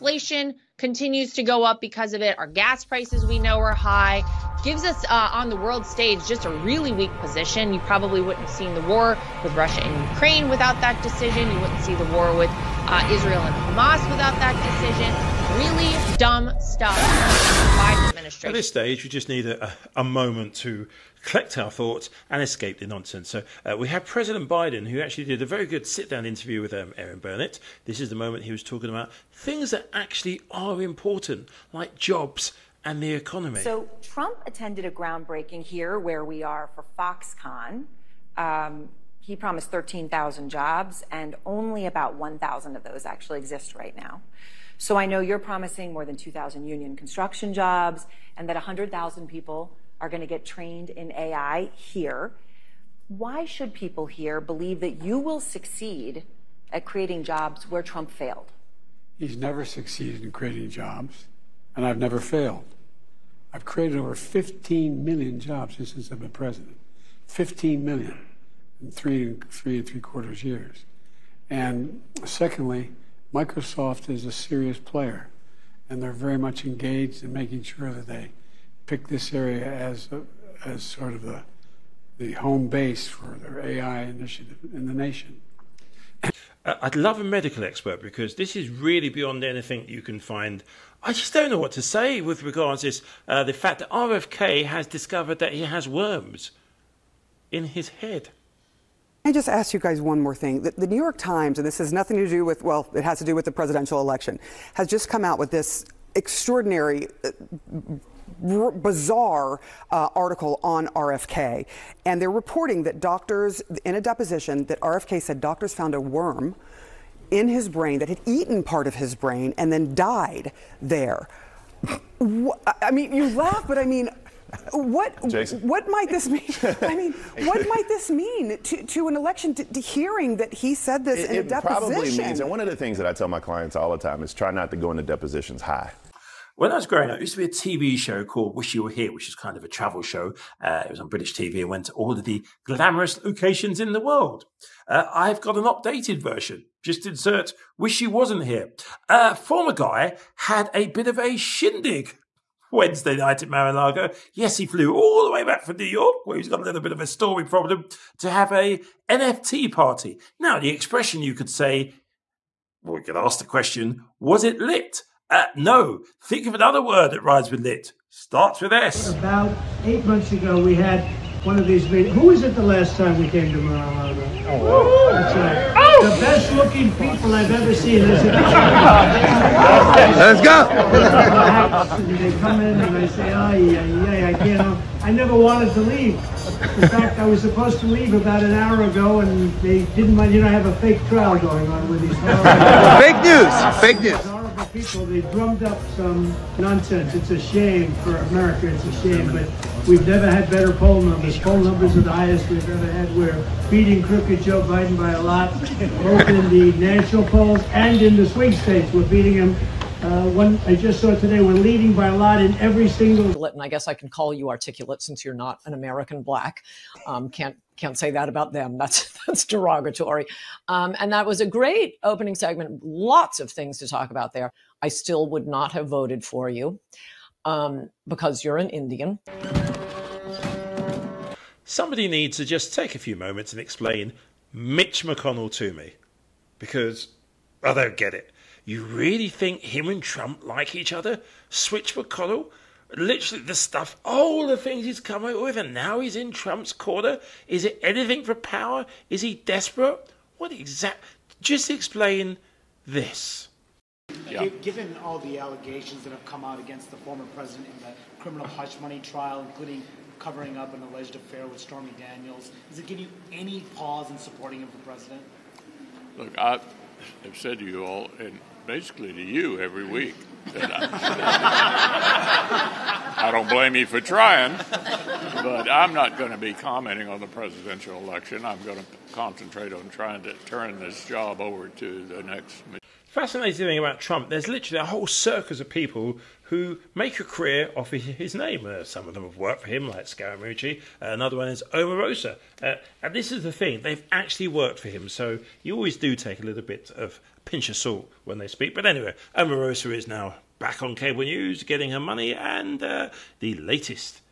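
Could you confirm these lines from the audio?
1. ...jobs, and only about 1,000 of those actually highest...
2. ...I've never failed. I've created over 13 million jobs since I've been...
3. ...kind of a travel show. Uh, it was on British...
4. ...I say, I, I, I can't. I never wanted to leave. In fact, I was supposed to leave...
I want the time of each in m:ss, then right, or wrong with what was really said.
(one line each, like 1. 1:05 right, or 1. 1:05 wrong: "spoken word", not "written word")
1. 0:40 wrong: "exist", not "highest"
2. 1:01 wrong: "15", not "13"
3. 2:19 right
4. 3:02 right.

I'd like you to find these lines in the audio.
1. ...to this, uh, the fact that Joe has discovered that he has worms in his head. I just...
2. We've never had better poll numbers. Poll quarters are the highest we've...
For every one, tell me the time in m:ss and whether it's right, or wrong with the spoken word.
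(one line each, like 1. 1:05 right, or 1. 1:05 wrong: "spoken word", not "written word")
1. 1:32 wrong: "RFK", not "Joe"
2. 3:19 wrong: "numbers", not "quarters".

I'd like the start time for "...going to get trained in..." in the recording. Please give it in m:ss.
0:50.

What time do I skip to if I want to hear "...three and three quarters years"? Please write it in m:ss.
1:09.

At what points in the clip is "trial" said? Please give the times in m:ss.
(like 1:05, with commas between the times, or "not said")
3:11, 4:18.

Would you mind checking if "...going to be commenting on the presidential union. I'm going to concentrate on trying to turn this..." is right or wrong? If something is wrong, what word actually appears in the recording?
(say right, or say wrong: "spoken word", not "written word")
wrong: "election", not "union".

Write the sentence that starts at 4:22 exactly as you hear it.
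Does it give you any pause in supporting him for president?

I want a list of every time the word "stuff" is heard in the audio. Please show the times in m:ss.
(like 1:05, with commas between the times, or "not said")
0:16, 4:03.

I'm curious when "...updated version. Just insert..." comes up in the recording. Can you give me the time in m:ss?
2:25.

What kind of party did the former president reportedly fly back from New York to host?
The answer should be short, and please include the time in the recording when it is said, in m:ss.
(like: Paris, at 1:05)
NFT party, at 2:39.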